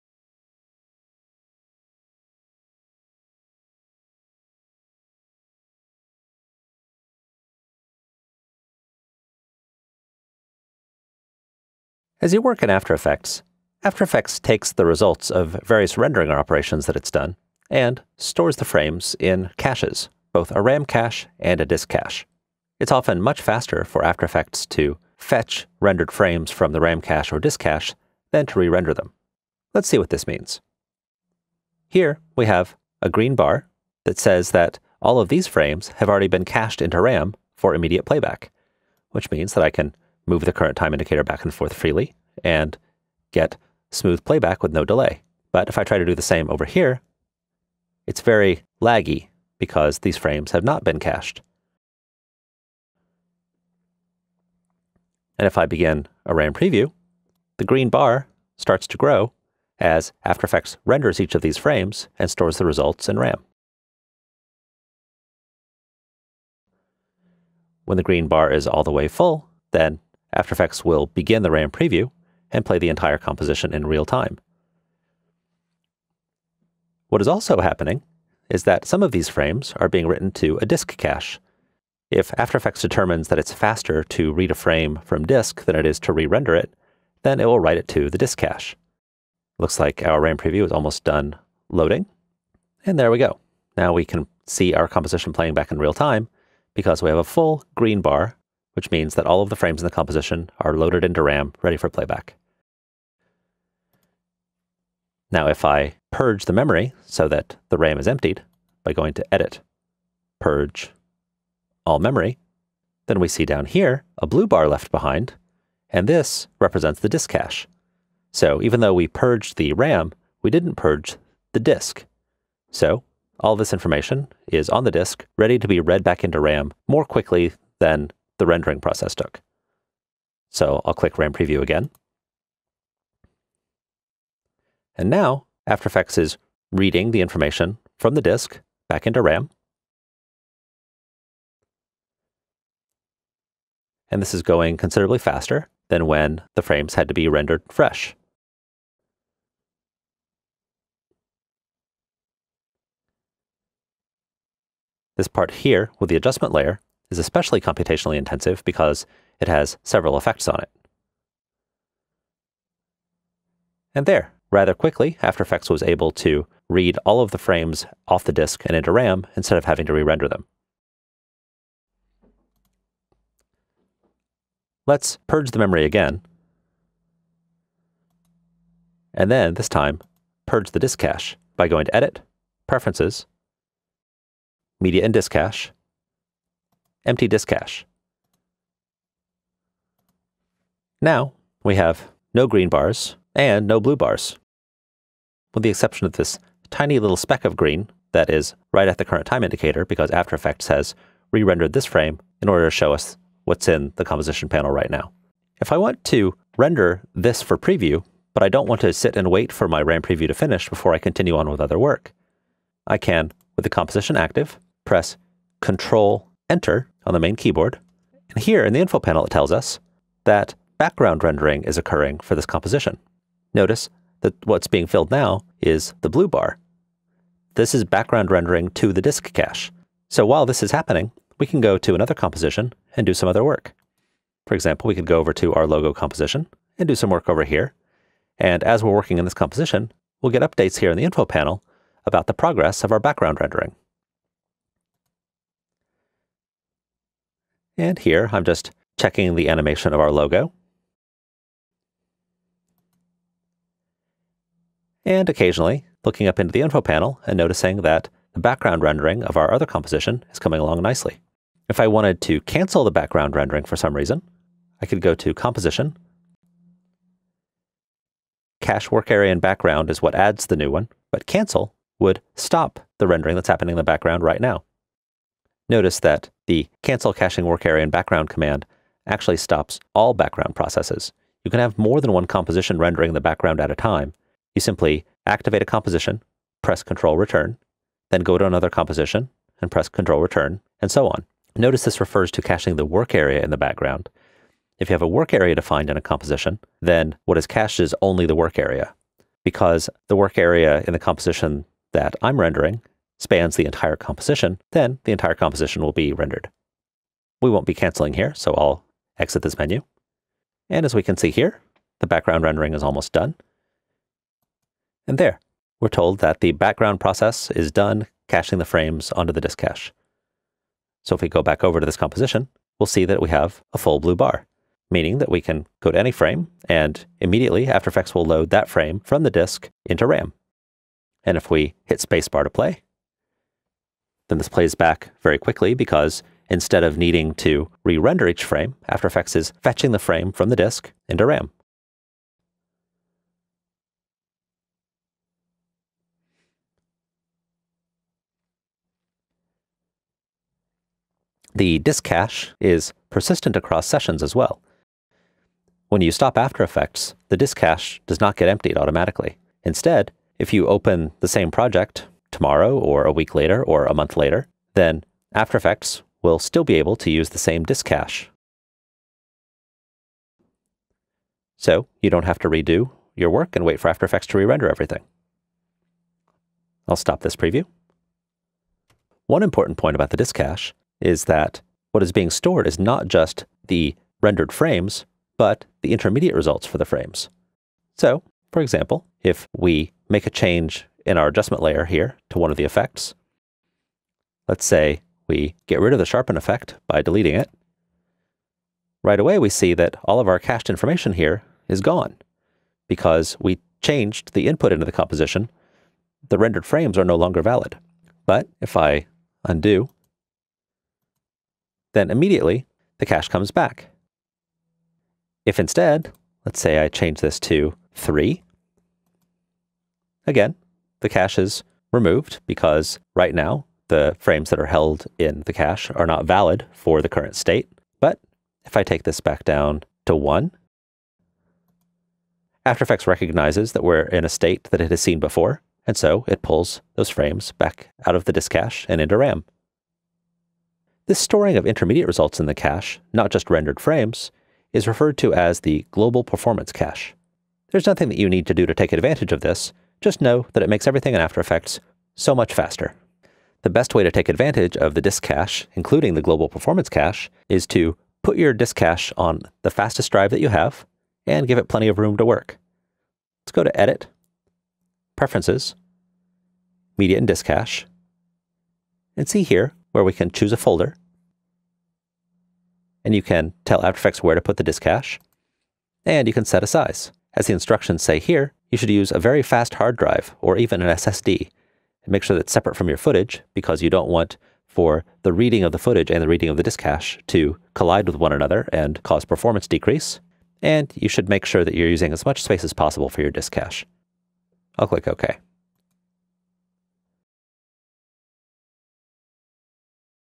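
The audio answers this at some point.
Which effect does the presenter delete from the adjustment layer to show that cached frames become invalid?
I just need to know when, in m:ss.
6:36.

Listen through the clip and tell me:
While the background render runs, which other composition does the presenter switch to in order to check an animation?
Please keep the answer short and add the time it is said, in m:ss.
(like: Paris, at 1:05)
Logo composition, at 3:55.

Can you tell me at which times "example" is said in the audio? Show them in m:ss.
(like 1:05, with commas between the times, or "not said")
3:54, 6:28.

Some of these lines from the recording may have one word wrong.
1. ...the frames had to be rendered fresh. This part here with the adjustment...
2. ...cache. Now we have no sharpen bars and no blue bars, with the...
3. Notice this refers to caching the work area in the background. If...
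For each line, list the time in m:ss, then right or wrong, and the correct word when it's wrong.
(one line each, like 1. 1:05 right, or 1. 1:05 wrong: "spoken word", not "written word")
1. 2:26 right
2. 3:07 wrong: "green", not "sharpen"
3. 4:51 right.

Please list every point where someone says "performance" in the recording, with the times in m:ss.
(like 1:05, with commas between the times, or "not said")
7:26, 7:36, 8:09.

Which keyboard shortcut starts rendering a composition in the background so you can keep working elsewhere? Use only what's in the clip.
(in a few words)
Control Enter.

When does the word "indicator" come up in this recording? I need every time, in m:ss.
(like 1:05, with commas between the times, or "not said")
0:40, 3:19.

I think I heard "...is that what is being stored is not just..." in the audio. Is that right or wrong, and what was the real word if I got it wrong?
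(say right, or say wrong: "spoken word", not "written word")
right.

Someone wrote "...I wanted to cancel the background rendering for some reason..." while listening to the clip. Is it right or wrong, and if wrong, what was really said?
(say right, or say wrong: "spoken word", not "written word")
right.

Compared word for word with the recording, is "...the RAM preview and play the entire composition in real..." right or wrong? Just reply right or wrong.
right.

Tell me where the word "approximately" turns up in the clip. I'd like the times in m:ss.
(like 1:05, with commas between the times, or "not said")
not said.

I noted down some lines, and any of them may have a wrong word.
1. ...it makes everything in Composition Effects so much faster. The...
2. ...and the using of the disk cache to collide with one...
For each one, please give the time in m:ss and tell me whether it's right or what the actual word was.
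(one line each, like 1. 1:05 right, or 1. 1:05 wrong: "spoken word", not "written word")
1. 7:30 wrong: "After", not "Composition"
2. 8:06 wrong: "reading", not "using".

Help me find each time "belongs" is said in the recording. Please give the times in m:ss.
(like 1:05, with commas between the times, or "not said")
not said.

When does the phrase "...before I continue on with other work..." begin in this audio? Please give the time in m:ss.
3:30.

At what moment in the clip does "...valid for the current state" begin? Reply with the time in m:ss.
7:06.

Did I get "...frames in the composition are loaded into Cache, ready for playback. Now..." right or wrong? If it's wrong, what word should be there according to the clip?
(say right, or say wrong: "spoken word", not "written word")
wrong: "RAM", not "Cache".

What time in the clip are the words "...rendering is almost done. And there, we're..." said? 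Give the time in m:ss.
5:12.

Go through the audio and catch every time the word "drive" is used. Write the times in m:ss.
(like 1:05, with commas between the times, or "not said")
7:40, 7:59.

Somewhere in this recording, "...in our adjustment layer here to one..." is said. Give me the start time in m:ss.
6:31.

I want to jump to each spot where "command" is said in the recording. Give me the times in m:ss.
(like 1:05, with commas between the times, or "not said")
4:38.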